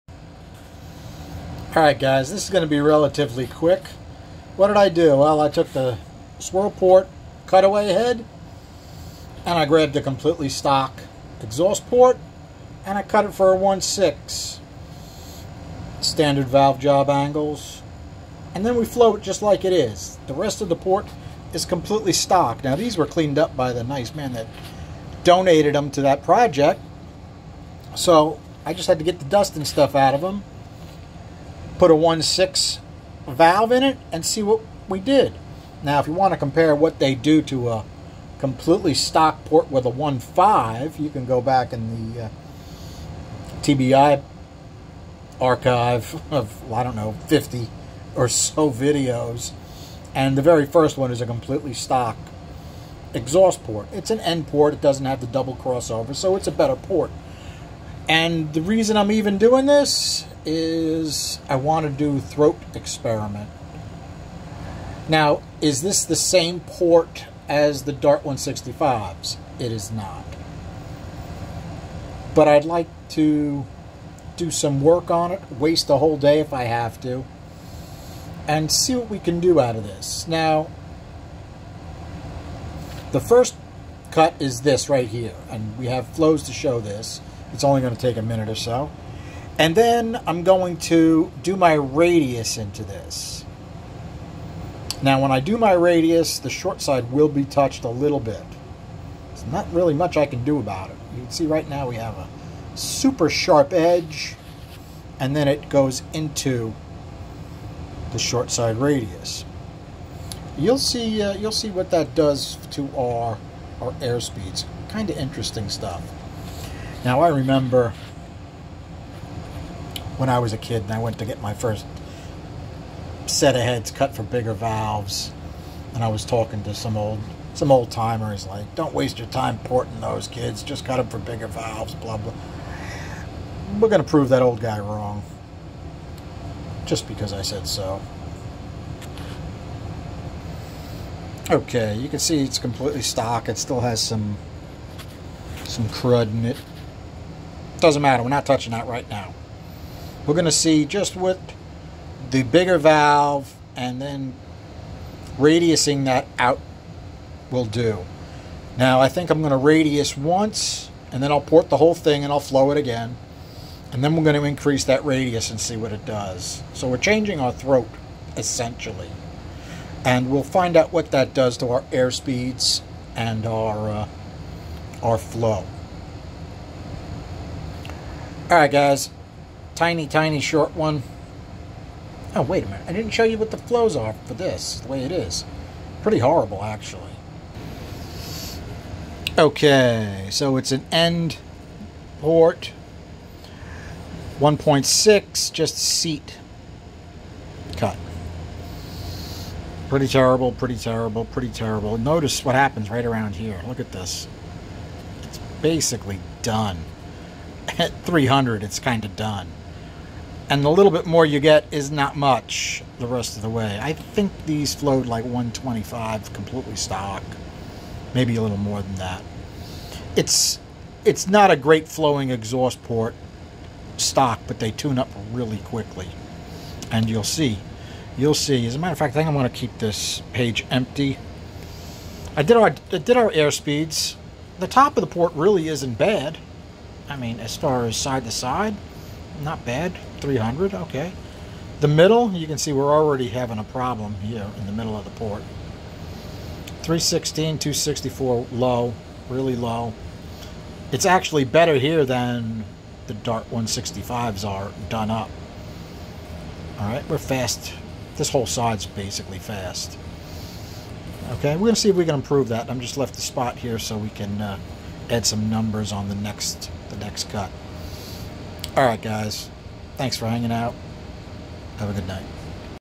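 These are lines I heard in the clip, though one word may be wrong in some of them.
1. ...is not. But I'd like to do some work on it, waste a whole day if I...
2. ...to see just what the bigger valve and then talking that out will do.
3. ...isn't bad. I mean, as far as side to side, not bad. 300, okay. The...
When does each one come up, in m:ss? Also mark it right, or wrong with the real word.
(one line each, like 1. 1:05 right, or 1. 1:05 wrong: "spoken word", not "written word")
1. 1:09 right
2. 2:30 wrong: "radiusing", not "talking"
3. 3:55 right.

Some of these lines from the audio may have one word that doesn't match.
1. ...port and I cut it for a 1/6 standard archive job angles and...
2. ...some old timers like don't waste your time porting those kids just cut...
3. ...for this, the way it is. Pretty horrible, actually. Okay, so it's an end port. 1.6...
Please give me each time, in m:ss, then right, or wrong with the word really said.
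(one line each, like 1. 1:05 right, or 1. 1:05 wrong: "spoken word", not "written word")
1. 0:11 wrong: "valve", not "archive"
2. 2:07 right
3. 3:04 right.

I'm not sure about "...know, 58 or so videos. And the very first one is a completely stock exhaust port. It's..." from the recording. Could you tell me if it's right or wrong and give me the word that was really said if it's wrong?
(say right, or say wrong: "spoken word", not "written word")
wrong: "50", not "58".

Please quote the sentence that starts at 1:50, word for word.
You'll see, uh, you'll see what that does to our, our speeds.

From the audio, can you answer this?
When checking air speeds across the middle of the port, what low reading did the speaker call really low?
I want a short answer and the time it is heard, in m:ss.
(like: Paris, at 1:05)
264, at 4:07.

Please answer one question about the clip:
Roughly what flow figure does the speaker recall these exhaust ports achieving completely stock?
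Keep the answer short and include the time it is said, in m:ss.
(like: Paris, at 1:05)
125, at 3:35.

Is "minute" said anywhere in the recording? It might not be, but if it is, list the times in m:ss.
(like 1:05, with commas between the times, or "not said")
1:28, 3:02.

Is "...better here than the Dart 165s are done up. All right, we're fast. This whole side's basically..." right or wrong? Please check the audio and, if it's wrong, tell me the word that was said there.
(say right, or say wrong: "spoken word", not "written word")
right.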